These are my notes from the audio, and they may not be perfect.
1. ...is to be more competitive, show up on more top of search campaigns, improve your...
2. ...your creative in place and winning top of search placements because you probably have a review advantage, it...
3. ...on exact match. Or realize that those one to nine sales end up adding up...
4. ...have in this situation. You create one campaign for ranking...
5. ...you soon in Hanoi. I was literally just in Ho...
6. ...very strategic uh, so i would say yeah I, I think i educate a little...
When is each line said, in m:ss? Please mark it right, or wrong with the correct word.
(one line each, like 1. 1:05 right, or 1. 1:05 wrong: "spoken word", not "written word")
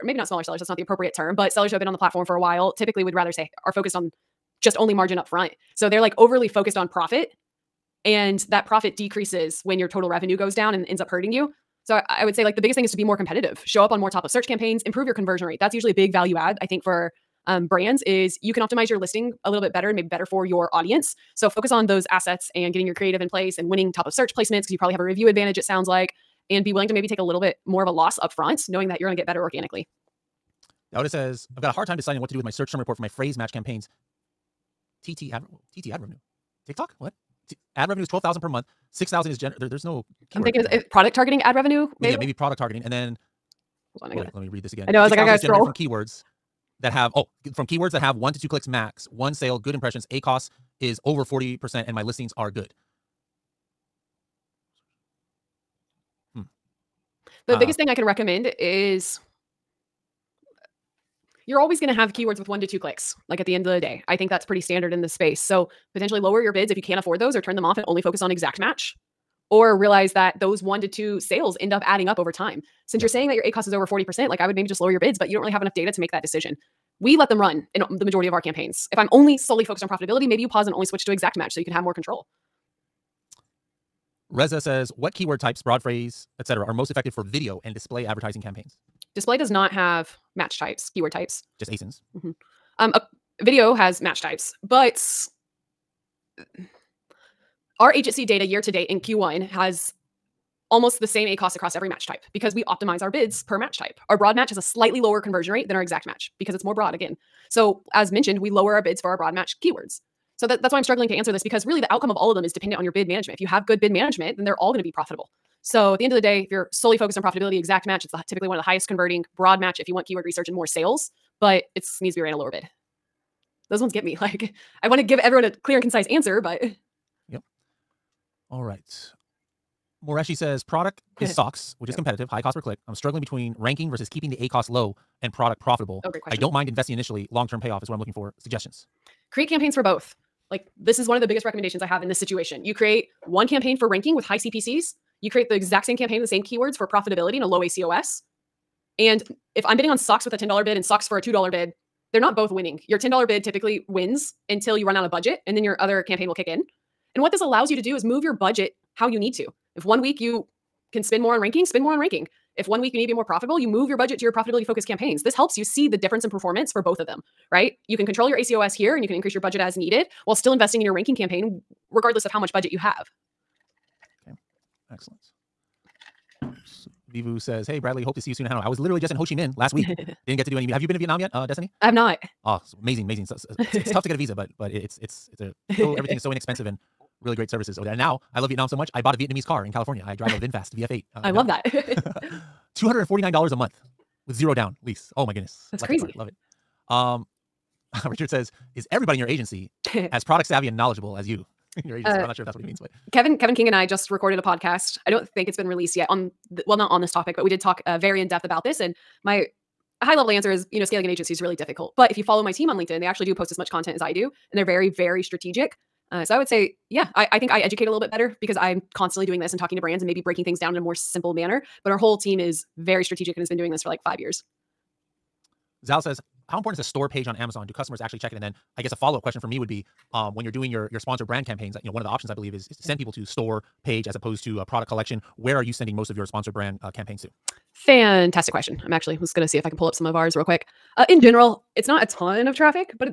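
1. 0:12 right
2. 0:22 right
3. 1:08 wrong: "two", not "nine"
4. 2:21 right
5. 2:58 right
6. 3:34 right.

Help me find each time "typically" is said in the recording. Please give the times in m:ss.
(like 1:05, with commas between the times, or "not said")
0:02, 1:58, 2:33.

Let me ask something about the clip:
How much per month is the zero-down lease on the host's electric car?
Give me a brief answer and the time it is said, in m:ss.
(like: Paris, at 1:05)
$249, at 3:12.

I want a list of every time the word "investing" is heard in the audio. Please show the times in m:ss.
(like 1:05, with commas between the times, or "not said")
2:16, 2:50.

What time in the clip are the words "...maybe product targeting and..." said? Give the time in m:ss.
0:42.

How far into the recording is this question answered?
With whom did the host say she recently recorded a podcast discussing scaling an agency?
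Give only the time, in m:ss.
3:23.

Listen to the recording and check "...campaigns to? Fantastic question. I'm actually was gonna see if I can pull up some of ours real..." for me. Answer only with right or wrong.
right.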